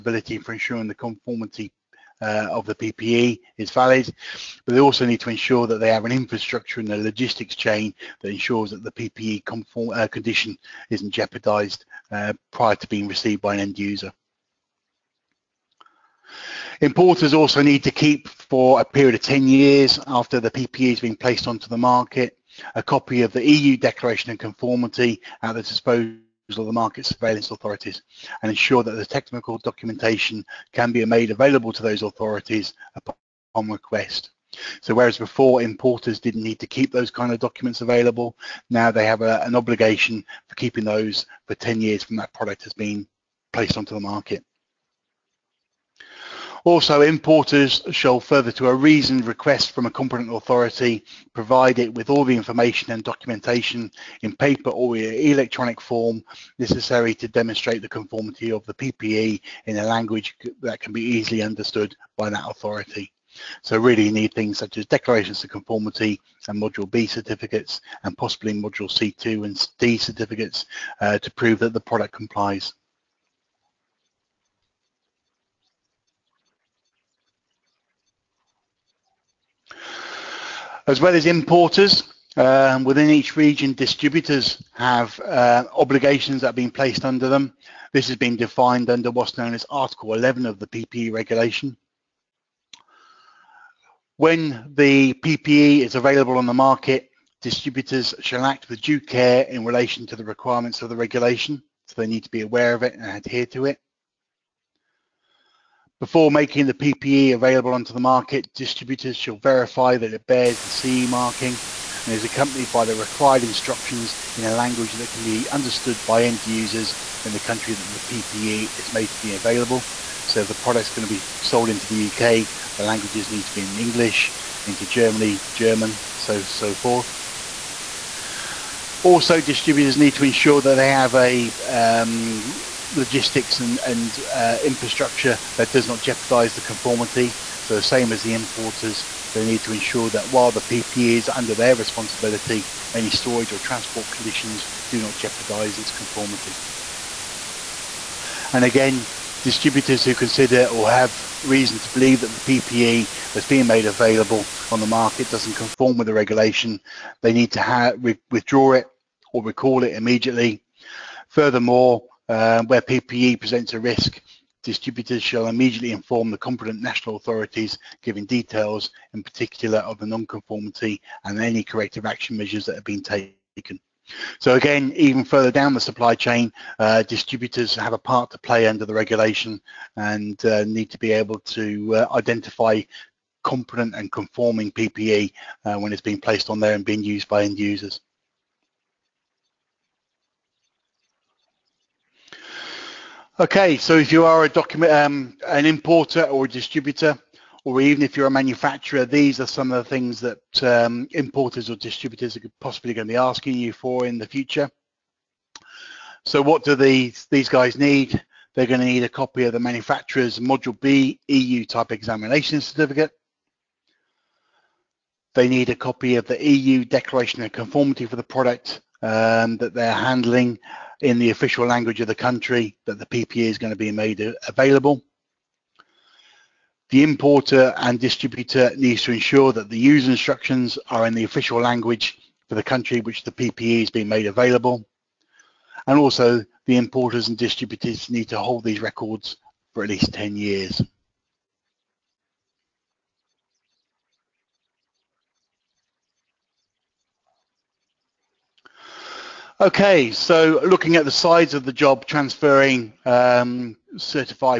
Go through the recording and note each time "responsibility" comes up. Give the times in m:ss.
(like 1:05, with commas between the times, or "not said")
2:21.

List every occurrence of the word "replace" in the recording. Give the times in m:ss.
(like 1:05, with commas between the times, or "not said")
not said.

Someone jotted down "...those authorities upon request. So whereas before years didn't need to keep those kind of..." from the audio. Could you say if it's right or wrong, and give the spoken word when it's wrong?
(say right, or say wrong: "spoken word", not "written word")
wrong: "importers", not "years".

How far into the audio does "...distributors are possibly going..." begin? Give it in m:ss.
3:21.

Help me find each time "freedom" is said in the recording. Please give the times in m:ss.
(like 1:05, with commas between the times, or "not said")
not said.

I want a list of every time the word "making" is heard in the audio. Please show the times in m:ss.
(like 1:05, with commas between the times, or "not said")
1:46.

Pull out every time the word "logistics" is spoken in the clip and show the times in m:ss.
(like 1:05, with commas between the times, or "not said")
0:06, 2:12.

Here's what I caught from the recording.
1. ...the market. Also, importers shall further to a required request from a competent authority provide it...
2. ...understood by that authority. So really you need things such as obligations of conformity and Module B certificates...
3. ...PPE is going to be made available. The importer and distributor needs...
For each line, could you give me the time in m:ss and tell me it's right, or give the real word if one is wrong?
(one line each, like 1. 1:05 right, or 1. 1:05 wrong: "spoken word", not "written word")
1. 0:43 wrong: "reasoned", not "required"
2. 1:01 wrong: "declarations", not "obligations"
3. 3:43 right.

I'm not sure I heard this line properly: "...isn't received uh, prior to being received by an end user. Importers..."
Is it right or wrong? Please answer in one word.
wrong.